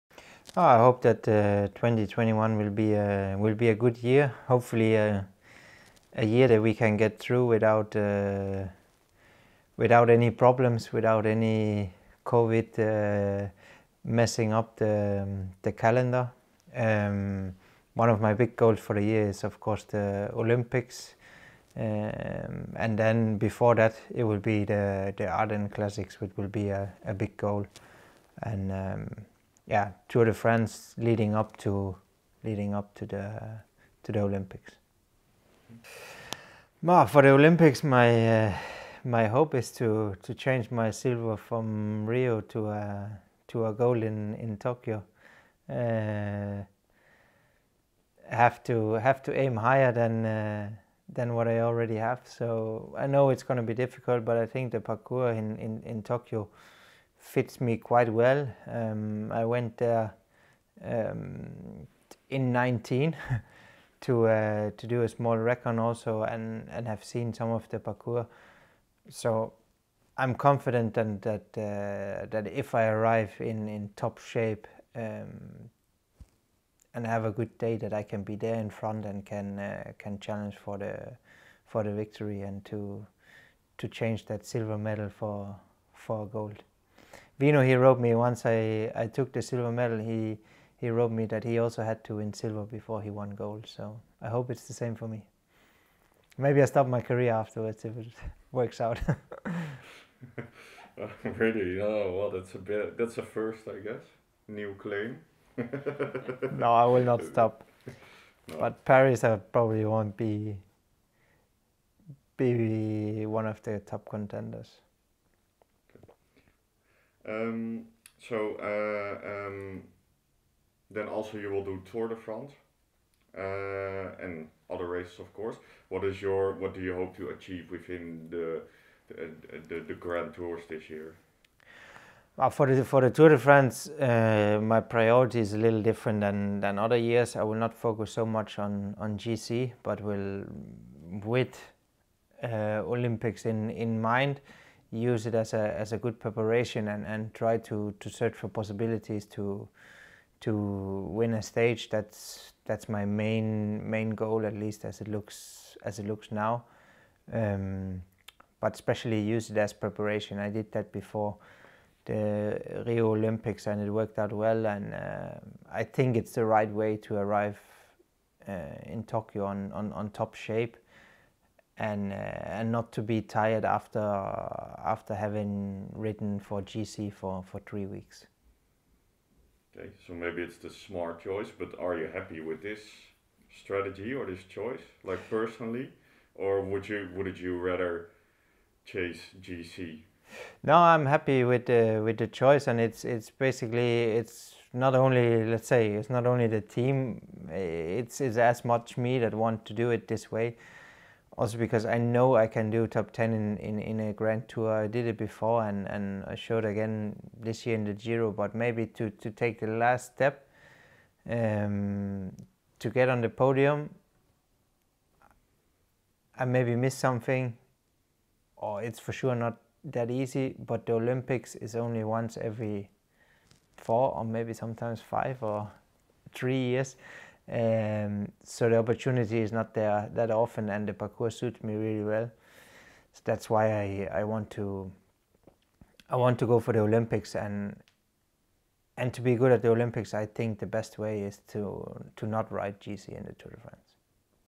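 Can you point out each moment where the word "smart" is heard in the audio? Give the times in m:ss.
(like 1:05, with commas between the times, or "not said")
3:00.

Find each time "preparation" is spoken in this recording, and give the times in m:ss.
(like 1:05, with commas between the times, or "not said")
2:26, 2:39.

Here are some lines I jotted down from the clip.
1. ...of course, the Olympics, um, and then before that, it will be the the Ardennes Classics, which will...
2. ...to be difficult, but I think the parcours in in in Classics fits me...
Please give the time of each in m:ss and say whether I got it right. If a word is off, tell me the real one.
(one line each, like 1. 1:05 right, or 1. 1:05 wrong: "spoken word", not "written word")
1. 0:19 right
2. 0:53 wrong: "Tokyo", not "Classics".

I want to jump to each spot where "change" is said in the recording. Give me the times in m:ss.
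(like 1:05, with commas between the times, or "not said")
0:40, 1:23.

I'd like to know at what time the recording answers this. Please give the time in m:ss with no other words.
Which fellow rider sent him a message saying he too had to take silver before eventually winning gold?
1:27.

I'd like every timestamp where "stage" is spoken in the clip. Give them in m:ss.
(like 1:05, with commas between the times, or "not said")
2:31.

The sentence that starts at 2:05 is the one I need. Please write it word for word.
What is your what do you hope to achieve within the the, eh, the, the Grand Tours this year?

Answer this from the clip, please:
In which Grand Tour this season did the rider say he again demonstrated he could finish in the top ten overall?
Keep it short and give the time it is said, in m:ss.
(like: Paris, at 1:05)
Giro, at 3:27.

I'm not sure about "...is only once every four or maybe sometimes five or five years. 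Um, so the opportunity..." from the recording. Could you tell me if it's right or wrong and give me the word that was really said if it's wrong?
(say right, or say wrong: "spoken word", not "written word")
wrong: "three", not "five".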